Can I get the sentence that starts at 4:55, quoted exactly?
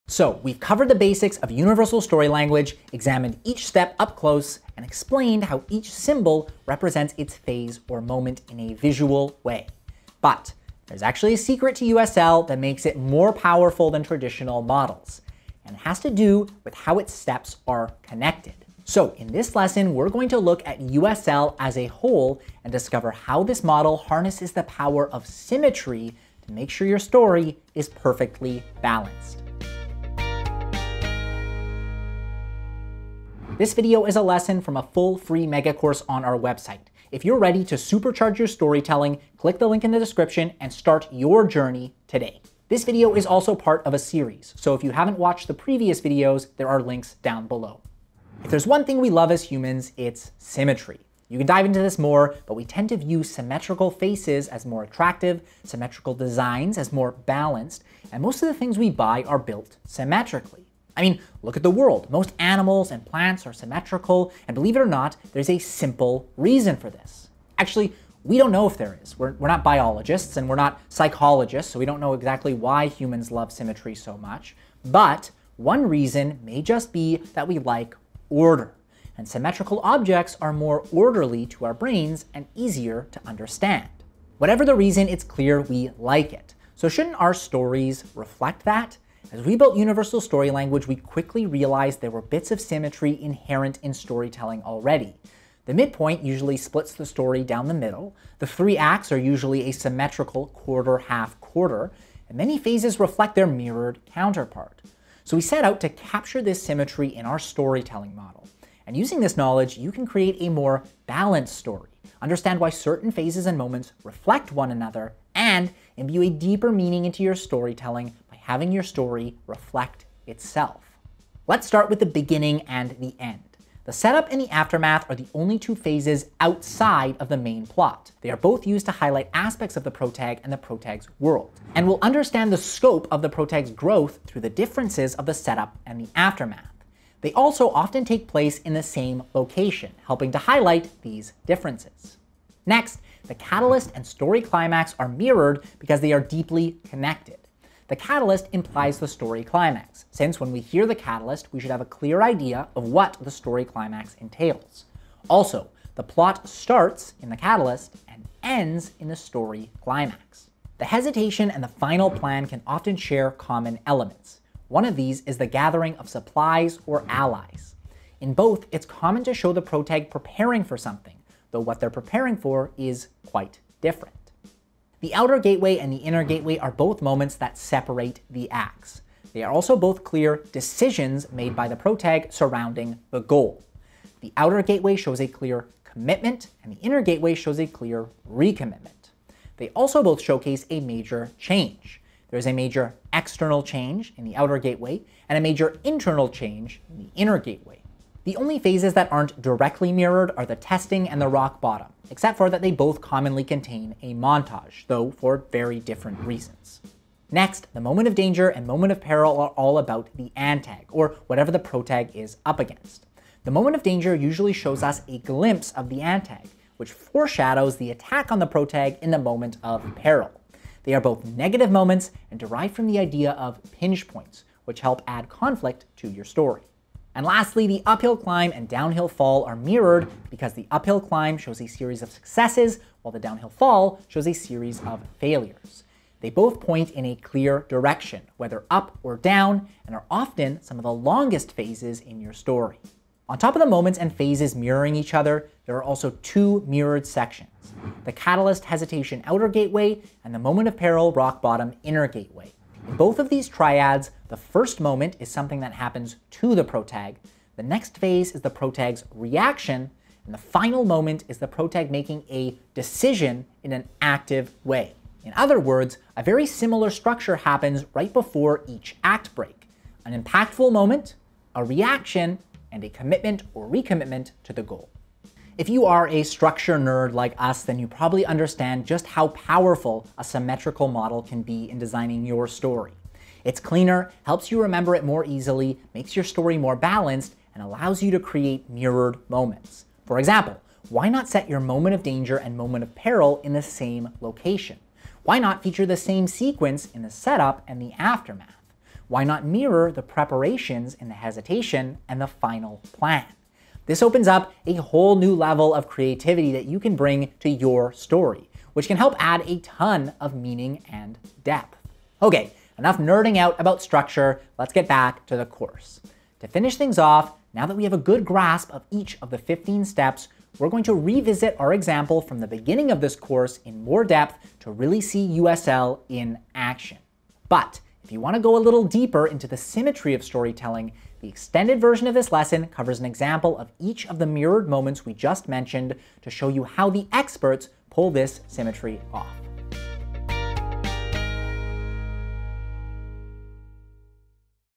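Why not feature the same sequence in the setup and the aftermath?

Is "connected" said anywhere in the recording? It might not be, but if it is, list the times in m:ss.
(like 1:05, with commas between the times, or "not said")
0:18, 2:26.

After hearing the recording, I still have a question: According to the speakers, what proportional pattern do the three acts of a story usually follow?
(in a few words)
quarter, half, quarter.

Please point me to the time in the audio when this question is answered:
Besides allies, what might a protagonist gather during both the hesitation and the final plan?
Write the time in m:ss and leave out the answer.
2:46.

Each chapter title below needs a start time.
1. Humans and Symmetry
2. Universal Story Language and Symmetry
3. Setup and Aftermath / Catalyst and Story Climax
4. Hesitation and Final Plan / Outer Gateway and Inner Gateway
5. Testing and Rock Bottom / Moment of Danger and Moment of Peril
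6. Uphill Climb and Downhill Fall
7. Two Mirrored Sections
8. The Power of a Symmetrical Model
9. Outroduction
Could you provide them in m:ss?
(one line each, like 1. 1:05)
1. 0:49
2. 1:29
3. 2:01
4. 2:41
5. 3:18
6. 3:47
7. 4:04
8. 4:36
9. 5:16.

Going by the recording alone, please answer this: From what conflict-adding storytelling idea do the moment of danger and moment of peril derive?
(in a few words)
pinch points.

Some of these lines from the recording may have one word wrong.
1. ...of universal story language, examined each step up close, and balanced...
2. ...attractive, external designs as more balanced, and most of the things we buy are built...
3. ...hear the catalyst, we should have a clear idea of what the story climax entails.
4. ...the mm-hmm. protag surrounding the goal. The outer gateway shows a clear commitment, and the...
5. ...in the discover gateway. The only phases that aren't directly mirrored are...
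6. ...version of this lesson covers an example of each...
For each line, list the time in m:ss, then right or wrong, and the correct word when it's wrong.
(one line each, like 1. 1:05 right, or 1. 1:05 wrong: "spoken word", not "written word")
1. 0:01 wrong: "explained", not "balanced"
2. 0:54 wrong: "symmetrical", not "external"
3. 2:30 right
4. 3:01 right
5. 3:16 wrong: "inner", not "discover"
6. 5:31 right.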